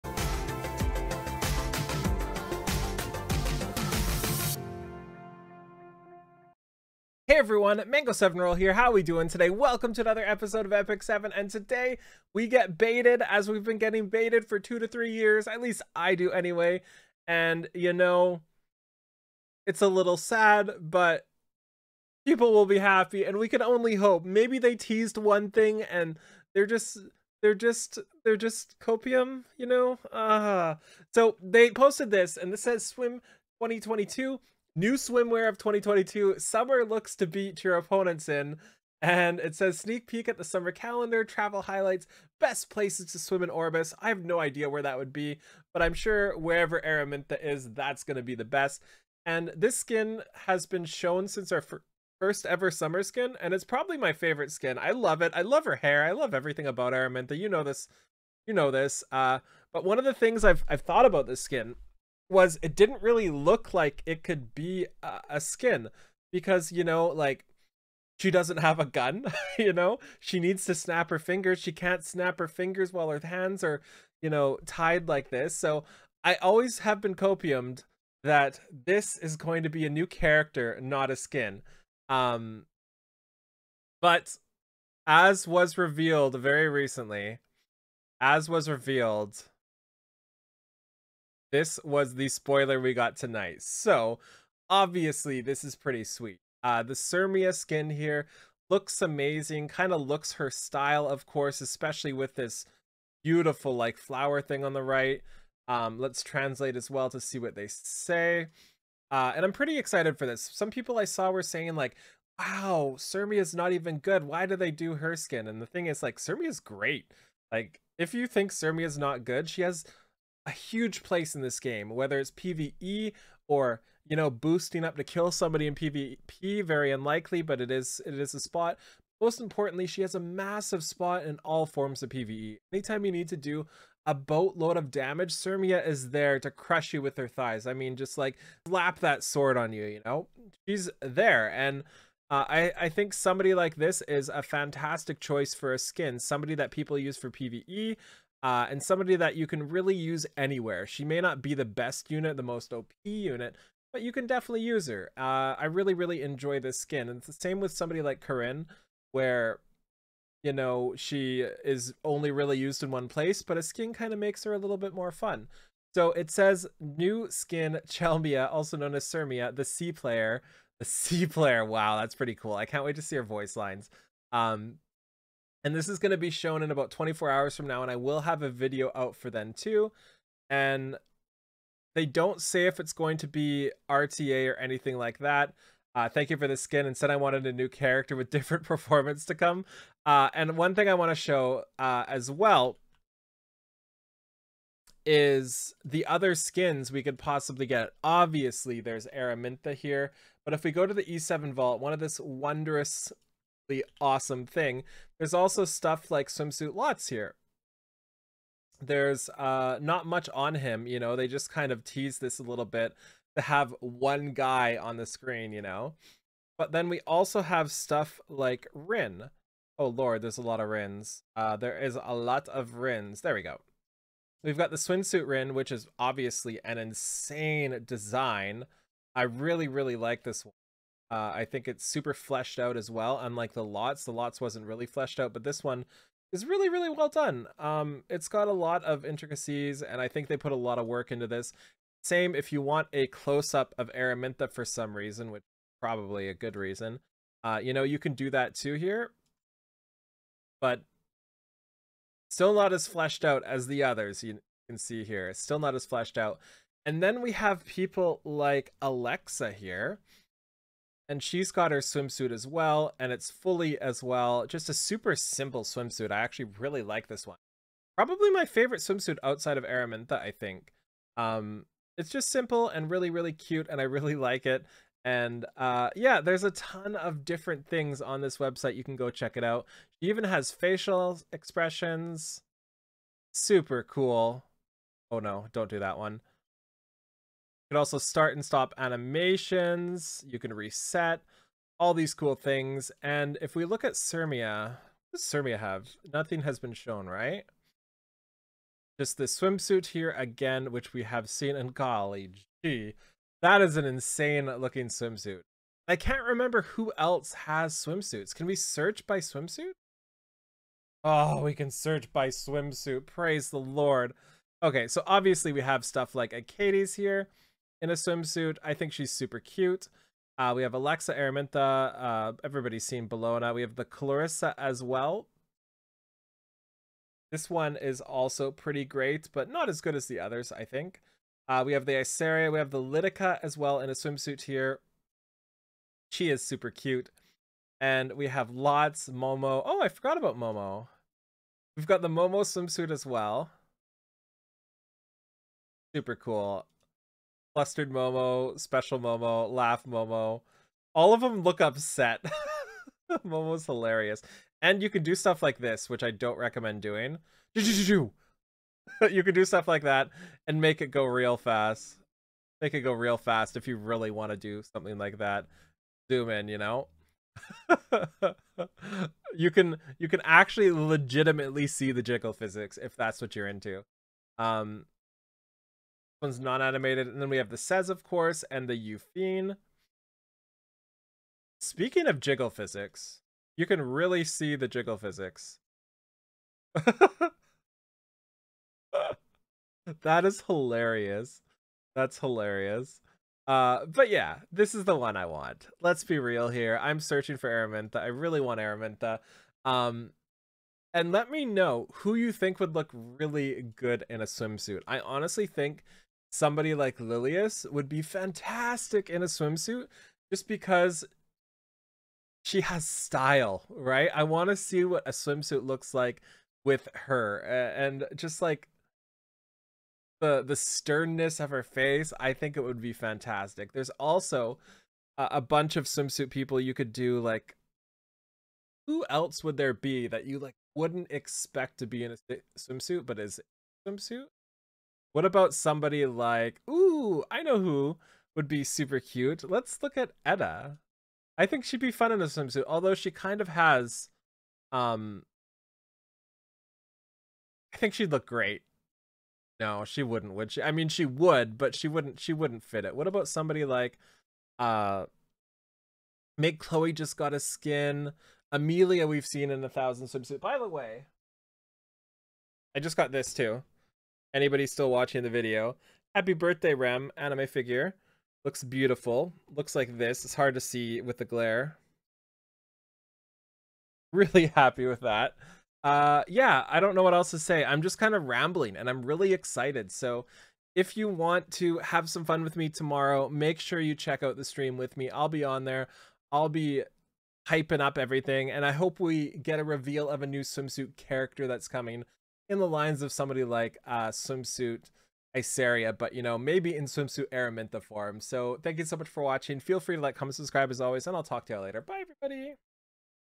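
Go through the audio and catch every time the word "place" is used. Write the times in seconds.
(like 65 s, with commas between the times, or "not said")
42 s, 121 s, 163 s.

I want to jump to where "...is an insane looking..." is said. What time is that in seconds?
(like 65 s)
303 s.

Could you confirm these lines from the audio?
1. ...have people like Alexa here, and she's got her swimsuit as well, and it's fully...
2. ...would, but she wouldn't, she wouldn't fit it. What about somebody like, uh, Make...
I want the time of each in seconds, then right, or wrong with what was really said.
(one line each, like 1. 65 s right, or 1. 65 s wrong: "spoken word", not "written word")
1. 257 s right
2. 451 s right.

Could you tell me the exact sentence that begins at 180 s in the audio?
And they don't say if it's going to be RTA or anything like that.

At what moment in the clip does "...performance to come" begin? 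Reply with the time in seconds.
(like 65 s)
188 s.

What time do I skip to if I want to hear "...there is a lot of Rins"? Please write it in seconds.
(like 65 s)
221 s.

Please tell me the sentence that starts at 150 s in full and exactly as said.
She may not be the best unit, the most OP unit, but you can definitely use her.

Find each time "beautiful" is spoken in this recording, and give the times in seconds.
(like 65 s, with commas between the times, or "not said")
103 s, 468 s.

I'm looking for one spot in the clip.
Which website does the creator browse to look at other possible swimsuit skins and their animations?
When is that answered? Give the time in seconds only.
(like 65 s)
201 s.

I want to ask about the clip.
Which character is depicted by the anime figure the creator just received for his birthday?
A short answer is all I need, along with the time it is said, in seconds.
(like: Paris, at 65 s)
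Rem, at 466 s.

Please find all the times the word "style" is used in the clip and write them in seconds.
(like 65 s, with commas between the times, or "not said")
100 s, 412 s.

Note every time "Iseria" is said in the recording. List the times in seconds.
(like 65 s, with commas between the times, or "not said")
331 s, 495 s.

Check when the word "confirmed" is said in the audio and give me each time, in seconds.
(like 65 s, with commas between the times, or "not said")
not said.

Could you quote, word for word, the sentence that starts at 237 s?
Um, it's got a lot of intricacies, and I think they put a lot of work into this.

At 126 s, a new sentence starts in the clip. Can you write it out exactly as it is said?
Very unlikely, but it is it is a spot.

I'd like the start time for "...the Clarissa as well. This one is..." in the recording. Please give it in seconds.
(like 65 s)
323 s.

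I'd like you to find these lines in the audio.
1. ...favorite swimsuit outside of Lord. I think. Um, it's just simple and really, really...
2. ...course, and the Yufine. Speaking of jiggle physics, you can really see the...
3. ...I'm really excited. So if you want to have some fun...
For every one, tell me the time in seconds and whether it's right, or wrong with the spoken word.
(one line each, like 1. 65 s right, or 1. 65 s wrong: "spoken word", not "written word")
1. 268 s wrong: "Araminta", not "Lord"
2. 378 s right
3. 478 s right.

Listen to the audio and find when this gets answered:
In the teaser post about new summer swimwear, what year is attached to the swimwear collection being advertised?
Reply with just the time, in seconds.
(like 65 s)
32 s.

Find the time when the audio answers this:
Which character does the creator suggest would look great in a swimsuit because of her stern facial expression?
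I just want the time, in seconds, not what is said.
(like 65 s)
406 s.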